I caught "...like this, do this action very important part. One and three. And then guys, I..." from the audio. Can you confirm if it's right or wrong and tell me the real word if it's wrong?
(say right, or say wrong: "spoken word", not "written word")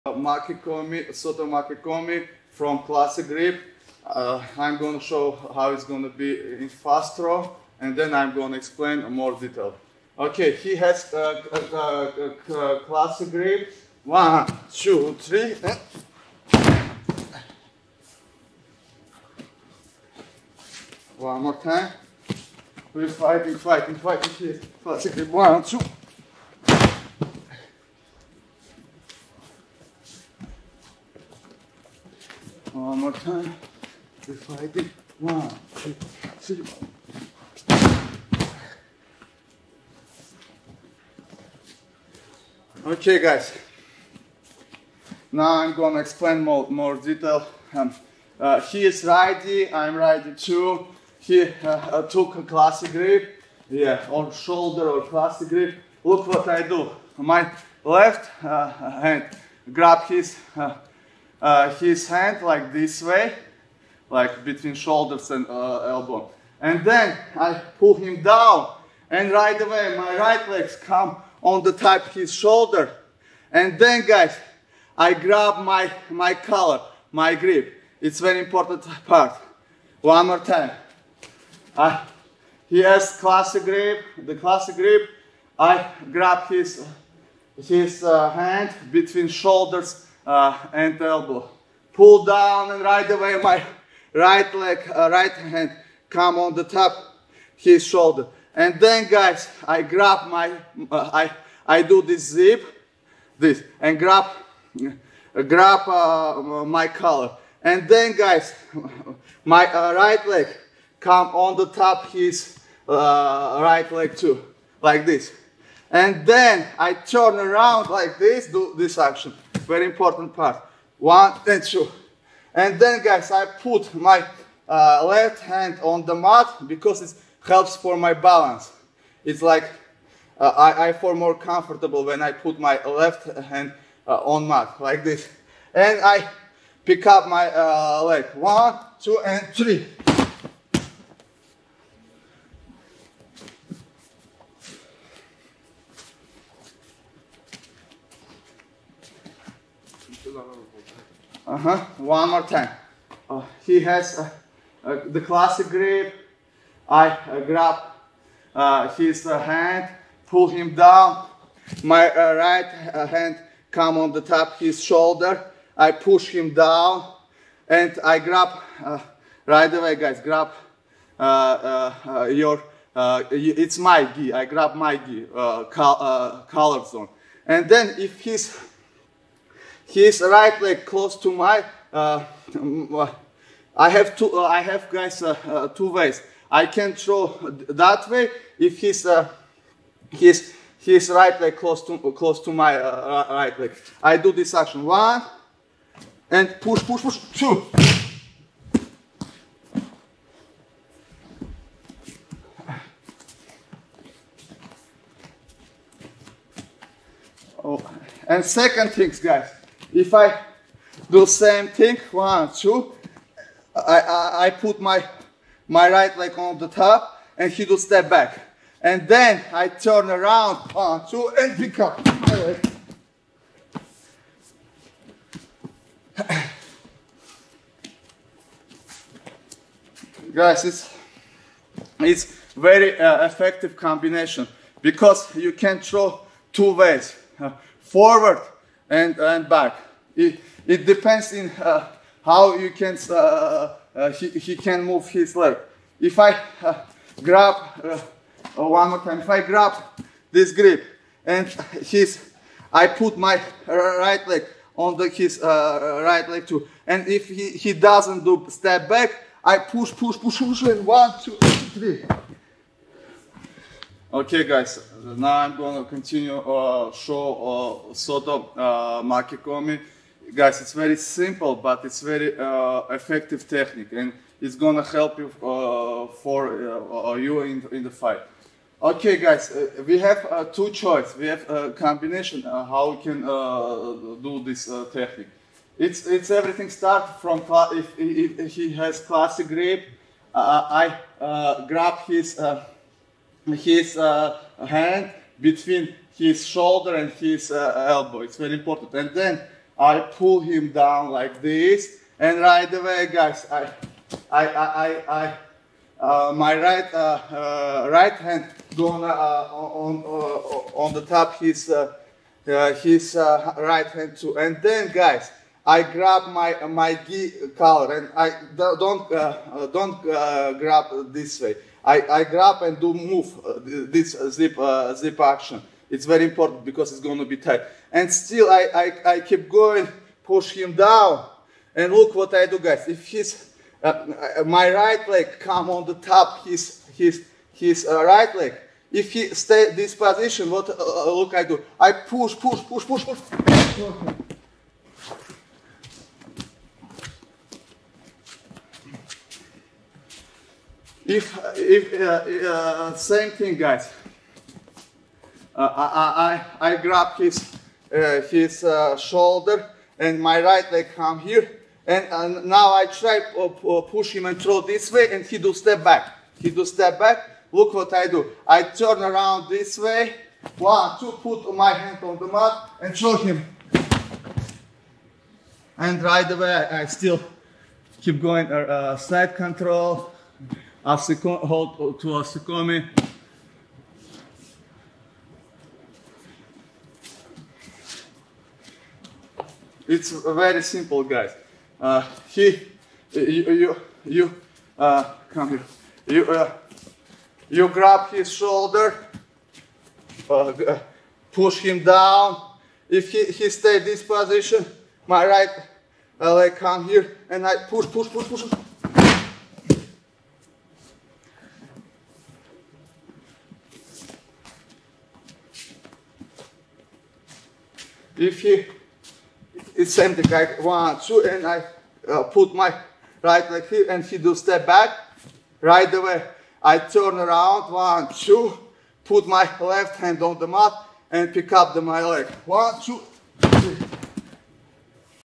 wrong: "two", not "three".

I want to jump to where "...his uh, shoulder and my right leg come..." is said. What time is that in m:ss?
5:58.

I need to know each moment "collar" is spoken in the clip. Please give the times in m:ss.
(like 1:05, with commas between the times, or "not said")
1:16, 1:46, 5:17.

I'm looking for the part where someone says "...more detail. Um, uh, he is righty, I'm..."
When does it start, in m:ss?
0:46.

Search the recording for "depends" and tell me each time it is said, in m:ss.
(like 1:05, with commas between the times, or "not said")
4:00.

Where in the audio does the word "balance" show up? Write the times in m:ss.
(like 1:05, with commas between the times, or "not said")
2:08.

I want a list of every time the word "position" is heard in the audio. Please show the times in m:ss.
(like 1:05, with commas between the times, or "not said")
5:39, 6:44.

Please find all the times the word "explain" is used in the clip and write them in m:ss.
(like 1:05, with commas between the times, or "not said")
0:08, 0:45.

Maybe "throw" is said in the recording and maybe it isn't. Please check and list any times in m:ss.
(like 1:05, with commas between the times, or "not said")
0:07, 3:06, 3:55, 6:04, 6:12.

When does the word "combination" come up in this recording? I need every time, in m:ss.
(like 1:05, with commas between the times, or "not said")
3:53, 4:41.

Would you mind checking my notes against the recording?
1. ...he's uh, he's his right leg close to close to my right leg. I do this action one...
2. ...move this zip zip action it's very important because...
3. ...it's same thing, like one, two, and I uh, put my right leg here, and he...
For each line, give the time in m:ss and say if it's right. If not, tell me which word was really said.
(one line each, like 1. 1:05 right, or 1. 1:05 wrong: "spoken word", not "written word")
1. 3:08 right
2. 5:22 right
3. 6:59 right.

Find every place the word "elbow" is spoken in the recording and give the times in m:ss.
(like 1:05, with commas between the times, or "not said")
1:05, 1:31, 4:57.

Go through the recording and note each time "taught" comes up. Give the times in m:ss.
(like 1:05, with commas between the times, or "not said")
not said.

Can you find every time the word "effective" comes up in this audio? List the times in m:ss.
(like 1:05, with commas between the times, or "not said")
3:53, 4:32.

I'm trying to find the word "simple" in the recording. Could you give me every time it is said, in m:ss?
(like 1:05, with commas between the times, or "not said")
4:30, 6:30.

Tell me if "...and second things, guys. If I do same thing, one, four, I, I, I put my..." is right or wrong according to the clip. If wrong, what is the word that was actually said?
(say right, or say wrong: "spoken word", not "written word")
wrong: "two", not "four".